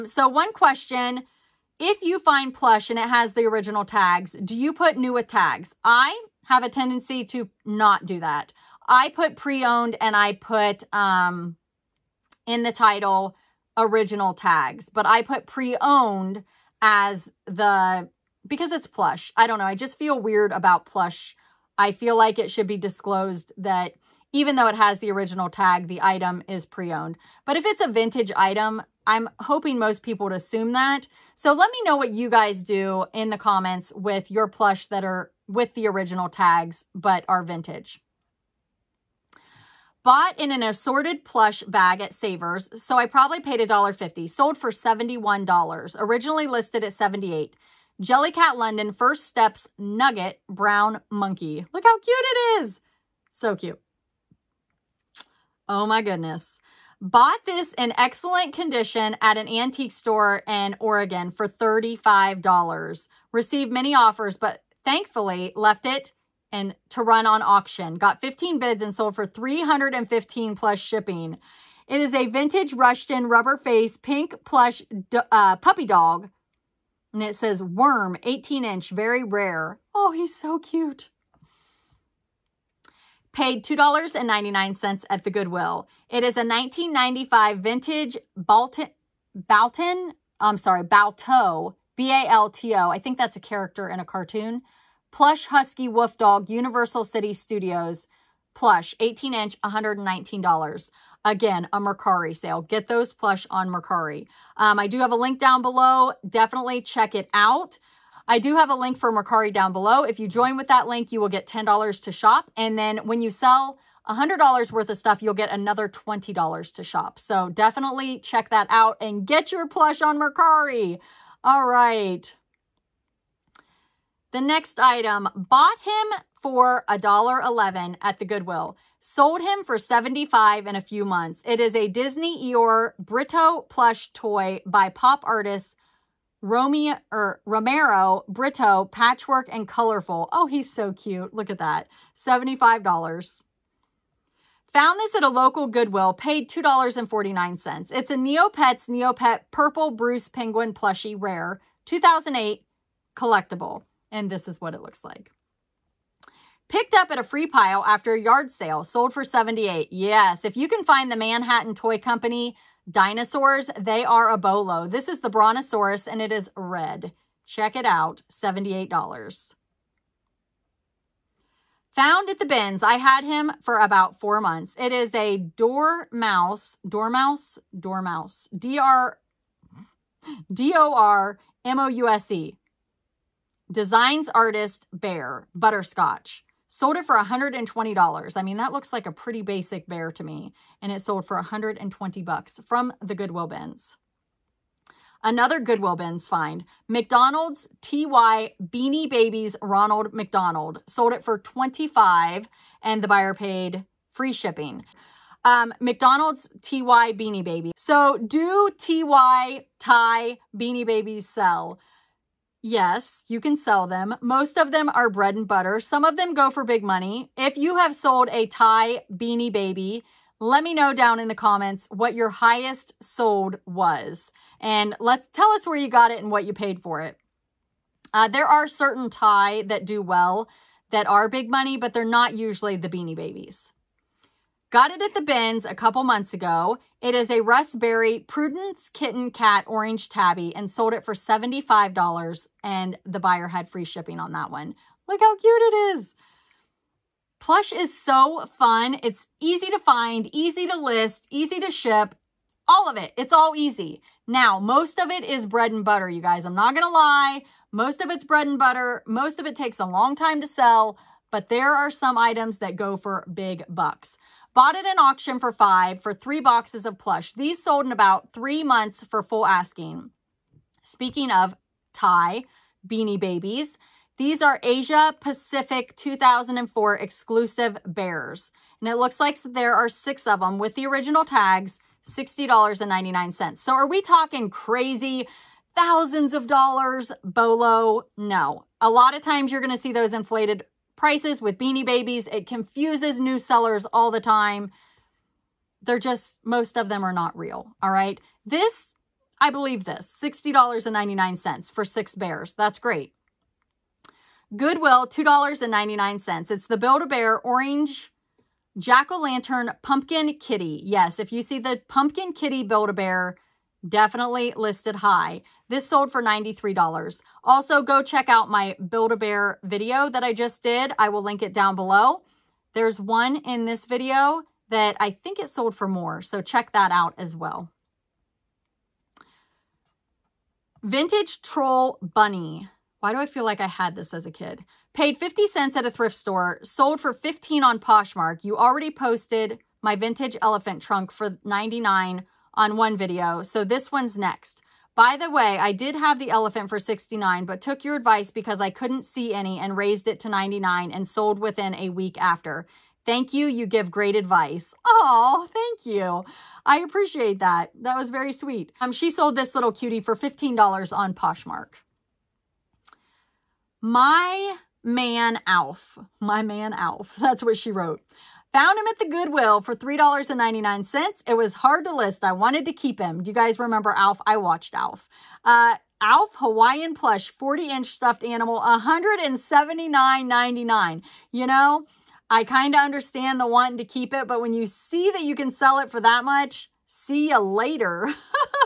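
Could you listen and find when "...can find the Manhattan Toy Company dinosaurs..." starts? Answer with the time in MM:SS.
02:40.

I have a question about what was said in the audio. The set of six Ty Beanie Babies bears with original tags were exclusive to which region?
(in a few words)
Asia Pacific.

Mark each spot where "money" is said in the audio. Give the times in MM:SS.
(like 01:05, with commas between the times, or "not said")
03:36, 03:51.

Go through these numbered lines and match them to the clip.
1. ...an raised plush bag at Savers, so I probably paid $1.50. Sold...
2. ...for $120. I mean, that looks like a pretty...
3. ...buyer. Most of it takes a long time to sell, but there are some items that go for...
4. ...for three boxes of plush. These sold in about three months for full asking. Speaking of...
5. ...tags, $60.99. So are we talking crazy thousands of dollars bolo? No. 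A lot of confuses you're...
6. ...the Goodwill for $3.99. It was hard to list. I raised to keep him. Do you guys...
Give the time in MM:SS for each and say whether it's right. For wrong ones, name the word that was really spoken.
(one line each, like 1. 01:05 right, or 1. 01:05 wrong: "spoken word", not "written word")
1. 00:40 wrong: "assorted", not "raised"
2. 03:07 right
3. 04:18 wrong: "butter", not "buyer"
4. 04:26 right
5. 04:41 wrong: "times", not "confuses"
6. 06:08 wrong: "wanted", not "raised".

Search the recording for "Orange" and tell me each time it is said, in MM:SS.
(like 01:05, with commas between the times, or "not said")
03:59, 05:07.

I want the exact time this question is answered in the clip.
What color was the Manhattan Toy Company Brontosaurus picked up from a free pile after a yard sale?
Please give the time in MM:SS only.
02:46.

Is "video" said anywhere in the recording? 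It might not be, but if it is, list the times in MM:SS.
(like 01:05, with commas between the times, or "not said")
05:19, 05:23, 05:42.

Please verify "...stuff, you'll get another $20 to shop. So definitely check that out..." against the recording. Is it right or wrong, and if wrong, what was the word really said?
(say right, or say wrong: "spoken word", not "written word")
right.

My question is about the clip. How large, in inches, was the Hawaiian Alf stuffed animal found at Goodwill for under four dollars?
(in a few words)
40 inch.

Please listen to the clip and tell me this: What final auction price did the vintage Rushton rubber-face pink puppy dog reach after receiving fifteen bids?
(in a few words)
$315.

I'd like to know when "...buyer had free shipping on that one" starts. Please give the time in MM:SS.
04:03.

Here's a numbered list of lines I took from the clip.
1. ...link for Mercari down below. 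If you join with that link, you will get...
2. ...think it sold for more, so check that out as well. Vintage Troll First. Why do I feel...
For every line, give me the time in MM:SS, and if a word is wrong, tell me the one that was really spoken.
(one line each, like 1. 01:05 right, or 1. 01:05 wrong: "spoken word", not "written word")
1. 01:48 right
2. 05:25 wrong: "Bunny", not "First".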